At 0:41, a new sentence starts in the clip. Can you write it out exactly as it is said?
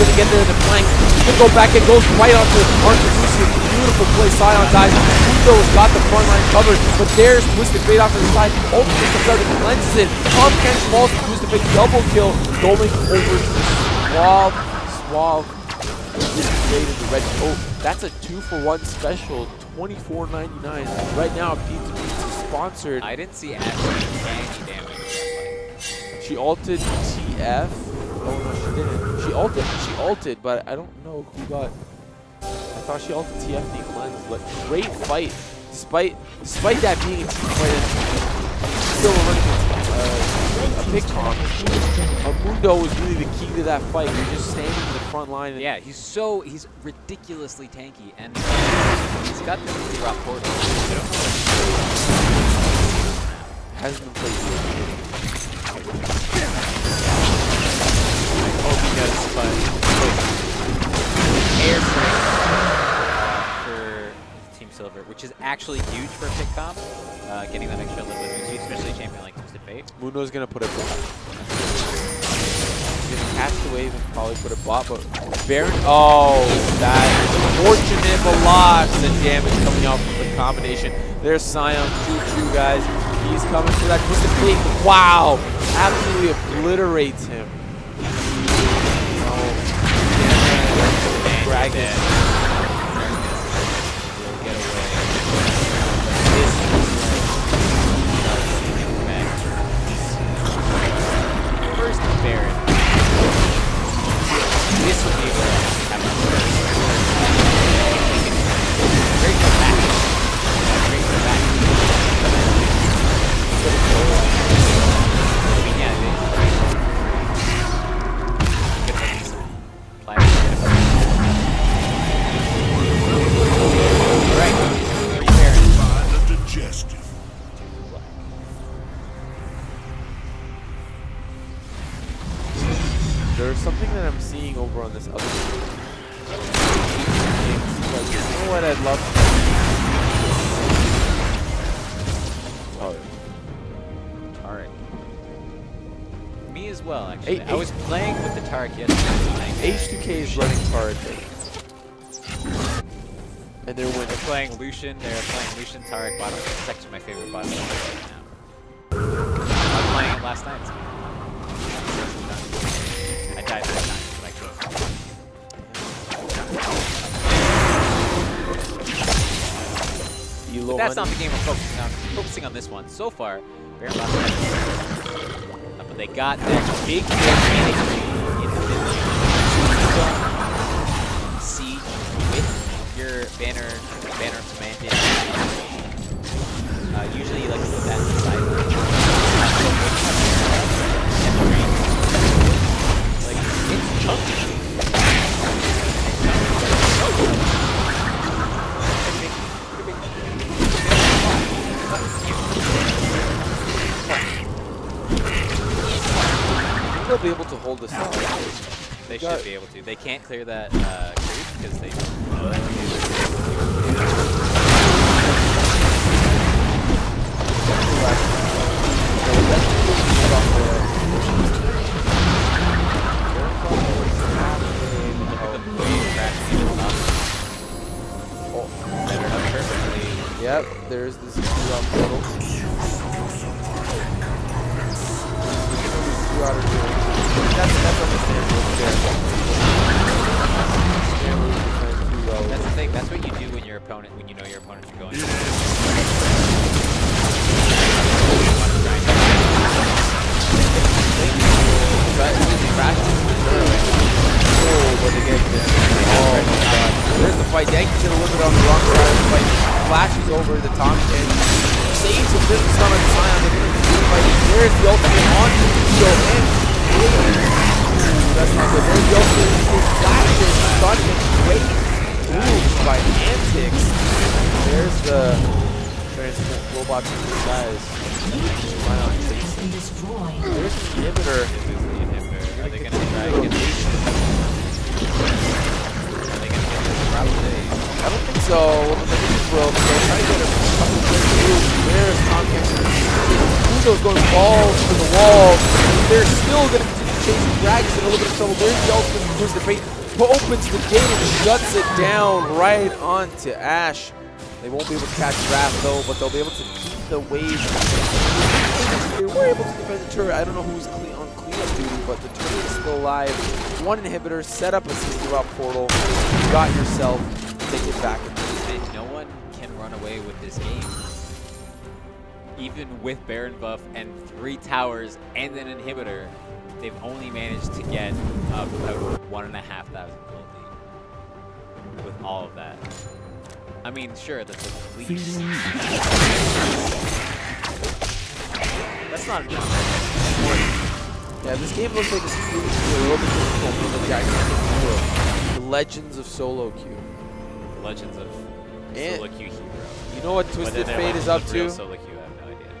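was really the key to that fight.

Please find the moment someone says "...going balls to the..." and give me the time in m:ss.
4:54.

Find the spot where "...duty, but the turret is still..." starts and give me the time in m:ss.
5:11.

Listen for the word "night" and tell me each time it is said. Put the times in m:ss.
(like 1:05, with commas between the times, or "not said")
2:40.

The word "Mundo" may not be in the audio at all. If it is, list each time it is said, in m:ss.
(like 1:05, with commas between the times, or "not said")
0:04, 1:09.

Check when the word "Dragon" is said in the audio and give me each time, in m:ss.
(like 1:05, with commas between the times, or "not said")
1:31, 4:57.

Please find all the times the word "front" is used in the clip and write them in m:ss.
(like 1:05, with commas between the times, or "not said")
0:06, 0:45.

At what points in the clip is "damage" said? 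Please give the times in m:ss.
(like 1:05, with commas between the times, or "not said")
0:24, 1:19.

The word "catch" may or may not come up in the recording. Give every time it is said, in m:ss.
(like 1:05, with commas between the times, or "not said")
1:13, 5:05.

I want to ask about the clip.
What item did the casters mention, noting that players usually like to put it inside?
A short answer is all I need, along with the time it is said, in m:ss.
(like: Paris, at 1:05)
Banner of Command, at 3:04.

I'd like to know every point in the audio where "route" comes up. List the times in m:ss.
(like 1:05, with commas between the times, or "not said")
4:47, 5:15.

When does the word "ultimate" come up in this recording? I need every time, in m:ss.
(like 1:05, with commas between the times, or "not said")
0:08, 4:24, 4:58.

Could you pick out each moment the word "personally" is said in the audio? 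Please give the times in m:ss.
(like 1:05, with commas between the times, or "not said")
not said.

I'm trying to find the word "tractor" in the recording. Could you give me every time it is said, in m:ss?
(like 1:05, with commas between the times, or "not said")
not said.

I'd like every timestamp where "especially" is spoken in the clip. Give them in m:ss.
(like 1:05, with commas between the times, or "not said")
1:08.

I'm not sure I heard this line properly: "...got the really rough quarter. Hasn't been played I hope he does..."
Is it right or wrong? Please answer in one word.
right.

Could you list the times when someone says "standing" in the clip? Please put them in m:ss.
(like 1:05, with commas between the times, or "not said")
0:44.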